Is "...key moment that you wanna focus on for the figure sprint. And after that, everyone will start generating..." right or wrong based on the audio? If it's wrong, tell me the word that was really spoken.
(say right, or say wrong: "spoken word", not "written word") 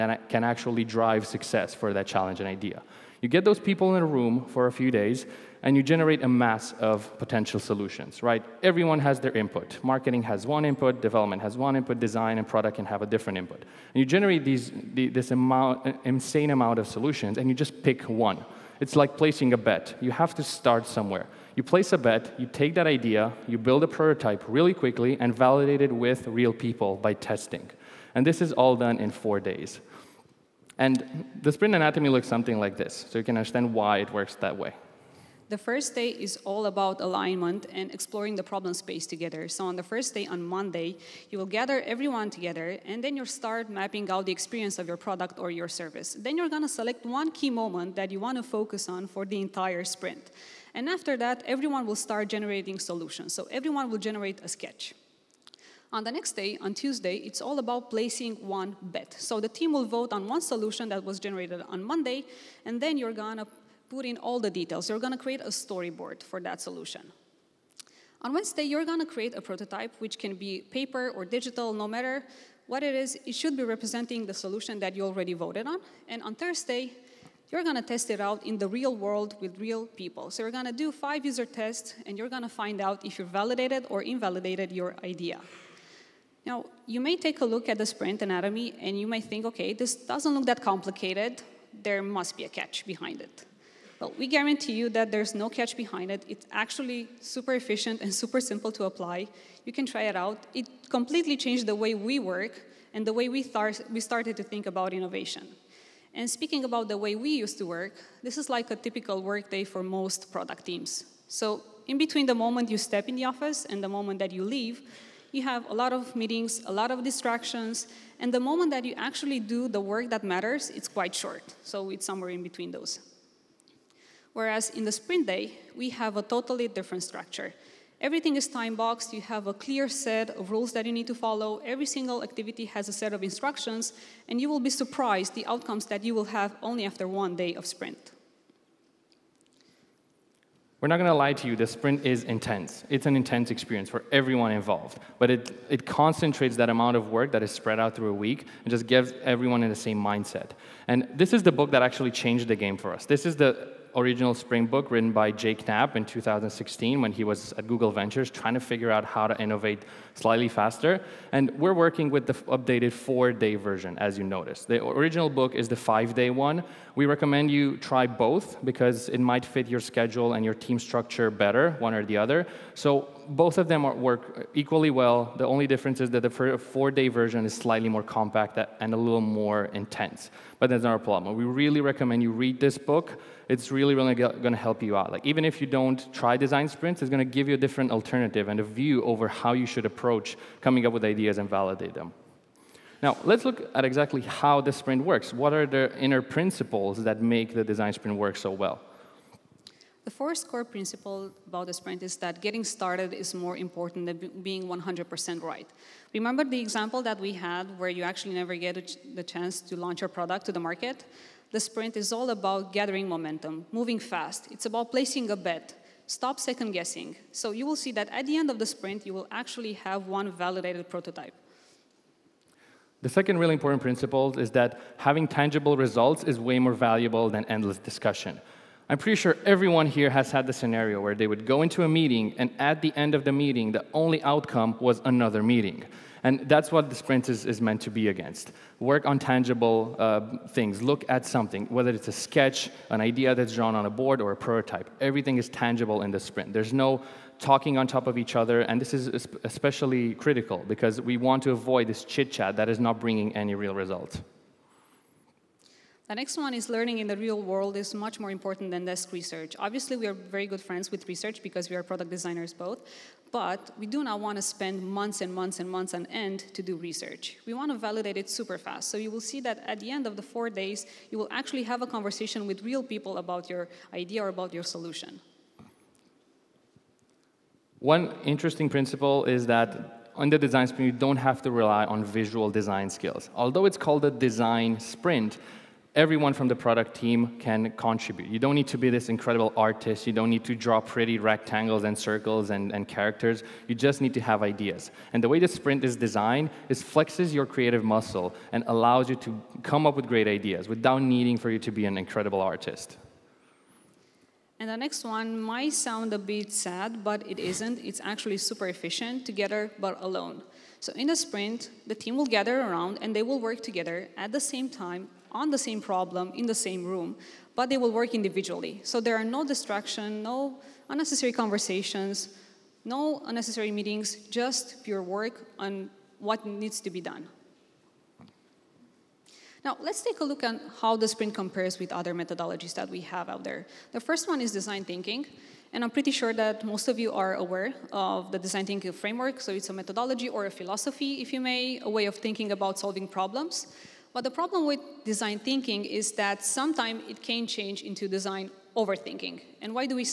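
wrong: "entire", not "figure".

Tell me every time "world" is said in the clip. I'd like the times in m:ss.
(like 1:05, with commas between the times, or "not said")
1:18, 4:17.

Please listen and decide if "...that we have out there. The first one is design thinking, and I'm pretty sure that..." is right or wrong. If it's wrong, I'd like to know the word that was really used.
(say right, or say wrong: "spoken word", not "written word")
right.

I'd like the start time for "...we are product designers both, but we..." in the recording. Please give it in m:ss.
4:21.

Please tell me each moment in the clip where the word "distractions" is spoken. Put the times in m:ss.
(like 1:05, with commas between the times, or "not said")
1:57, 5:19.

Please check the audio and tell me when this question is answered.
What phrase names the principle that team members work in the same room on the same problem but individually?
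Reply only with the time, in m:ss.
5:09.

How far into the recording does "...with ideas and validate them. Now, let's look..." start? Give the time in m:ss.
3:10.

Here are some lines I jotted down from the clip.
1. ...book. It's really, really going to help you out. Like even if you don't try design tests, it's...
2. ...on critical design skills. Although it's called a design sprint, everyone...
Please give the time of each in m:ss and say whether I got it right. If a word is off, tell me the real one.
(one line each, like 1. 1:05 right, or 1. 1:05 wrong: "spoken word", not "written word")
1. 3:02 wrong: "sprints", not "tests"
2. 4:41 wrong: "visual", not "critical".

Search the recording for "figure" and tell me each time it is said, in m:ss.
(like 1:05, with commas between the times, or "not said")
2:38.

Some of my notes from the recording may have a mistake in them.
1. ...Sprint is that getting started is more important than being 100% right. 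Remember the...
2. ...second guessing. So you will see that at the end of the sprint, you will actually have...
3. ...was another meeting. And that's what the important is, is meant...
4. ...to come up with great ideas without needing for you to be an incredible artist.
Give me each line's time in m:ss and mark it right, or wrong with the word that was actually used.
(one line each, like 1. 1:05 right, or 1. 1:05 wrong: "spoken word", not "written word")
1. 3:21 right
2. 3:36 right
3. 3:54 wrong: "sprint", not "important"
4. 4:59 right.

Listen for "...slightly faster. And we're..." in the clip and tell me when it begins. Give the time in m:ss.
2:40.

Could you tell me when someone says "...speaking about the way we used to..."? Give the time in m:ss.
1:46.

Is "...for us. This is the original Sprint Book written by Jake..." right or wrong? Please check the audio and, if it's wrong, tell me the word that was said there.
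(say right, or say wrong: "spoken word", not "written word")
right.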